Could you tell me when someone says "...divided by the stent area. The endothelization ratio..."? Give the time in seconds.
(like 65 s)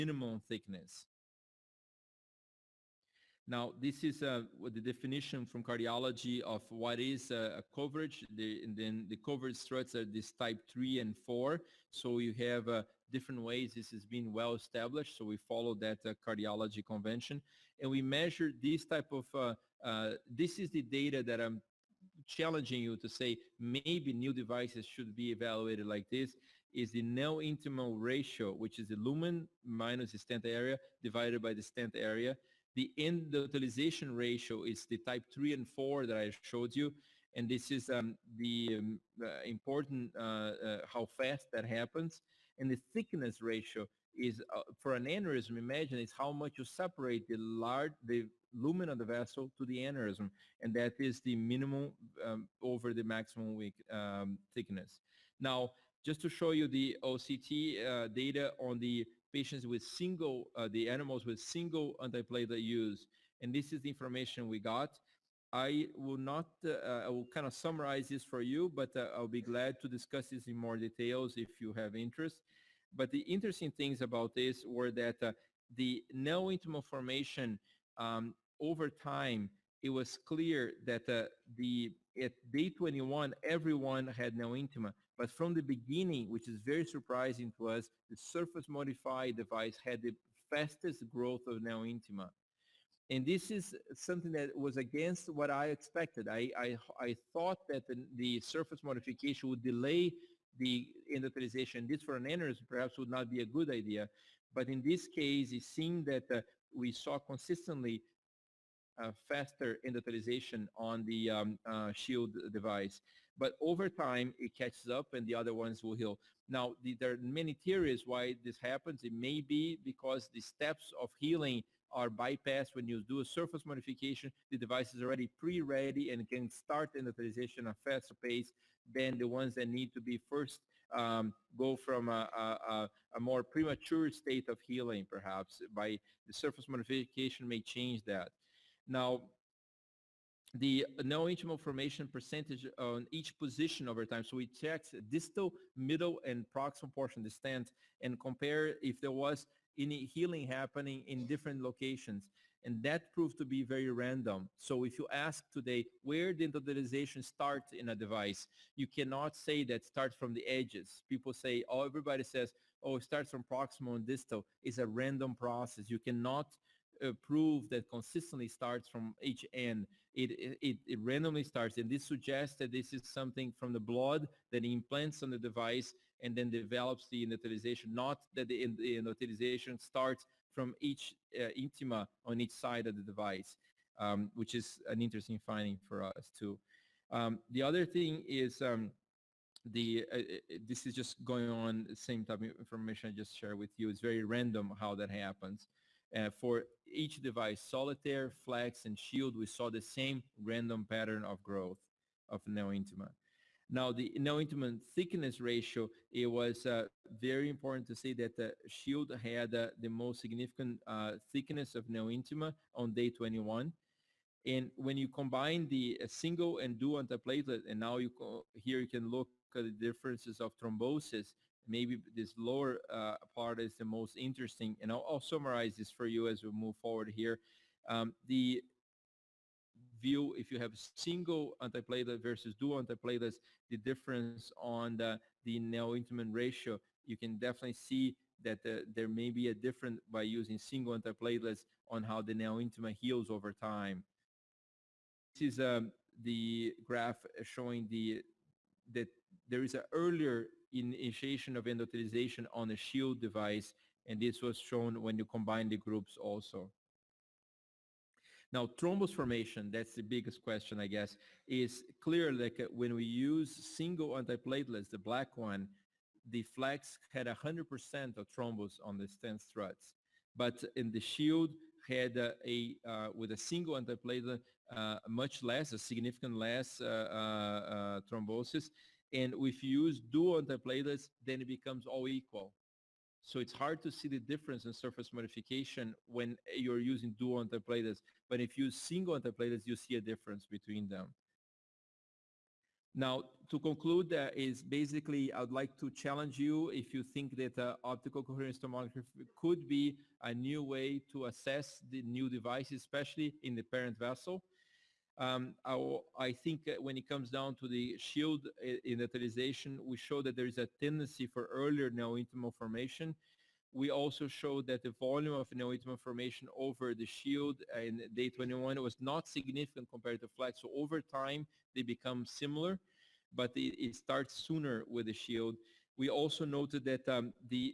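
31 s.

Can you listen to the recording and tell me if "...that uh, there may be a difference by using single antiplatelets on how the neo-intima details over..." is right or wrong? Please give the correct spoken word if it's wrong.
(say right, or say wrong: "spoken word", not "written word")
wrong: "heals", not "details".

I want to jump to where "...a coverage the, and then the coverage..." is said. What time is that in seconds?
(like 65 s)
7 s.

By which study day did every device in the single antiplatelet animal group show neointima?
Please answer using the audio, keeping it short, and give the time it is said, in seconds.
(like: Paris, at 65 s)
Day 21, at 82 s.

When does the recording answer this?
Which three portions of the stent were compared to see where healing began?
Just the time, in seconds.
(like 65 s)
145 s.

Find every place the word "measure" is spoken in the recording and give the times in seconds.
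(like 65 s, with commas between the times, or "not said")
18 s.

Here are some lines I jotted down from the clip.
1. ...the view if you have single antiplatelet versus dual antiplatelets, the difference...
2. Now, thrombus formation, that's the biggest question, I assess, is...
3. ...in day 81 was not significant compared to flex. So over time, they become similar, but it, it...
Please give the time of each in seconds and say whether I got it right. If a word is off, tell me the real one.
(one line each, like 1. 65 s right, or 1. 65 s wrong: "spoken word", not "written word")
1. 228 s right
2. 258 s wrong: "guess", not "assess"
3. 317 s wrong: "21", not "81".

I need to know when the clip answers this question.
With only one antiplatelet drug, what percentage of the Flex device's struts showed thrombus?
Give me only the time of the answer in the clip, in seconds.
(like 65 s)
267 s.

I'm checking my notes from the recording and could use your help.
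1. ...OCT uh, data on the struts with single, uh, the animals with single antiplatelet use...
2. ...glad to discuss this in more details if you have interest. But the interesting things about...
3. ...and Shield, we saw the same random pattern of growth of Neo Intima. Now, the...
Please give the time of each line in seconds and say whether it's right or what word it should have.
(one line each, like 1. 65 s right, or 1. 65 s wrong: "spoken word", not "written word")
1. 57 s wrong: "patients", not "struts"
2. 69 s right
3. 198 s right.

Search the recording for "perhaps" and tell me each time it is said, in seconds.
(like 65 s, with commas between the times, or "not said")
102 s, 135 s.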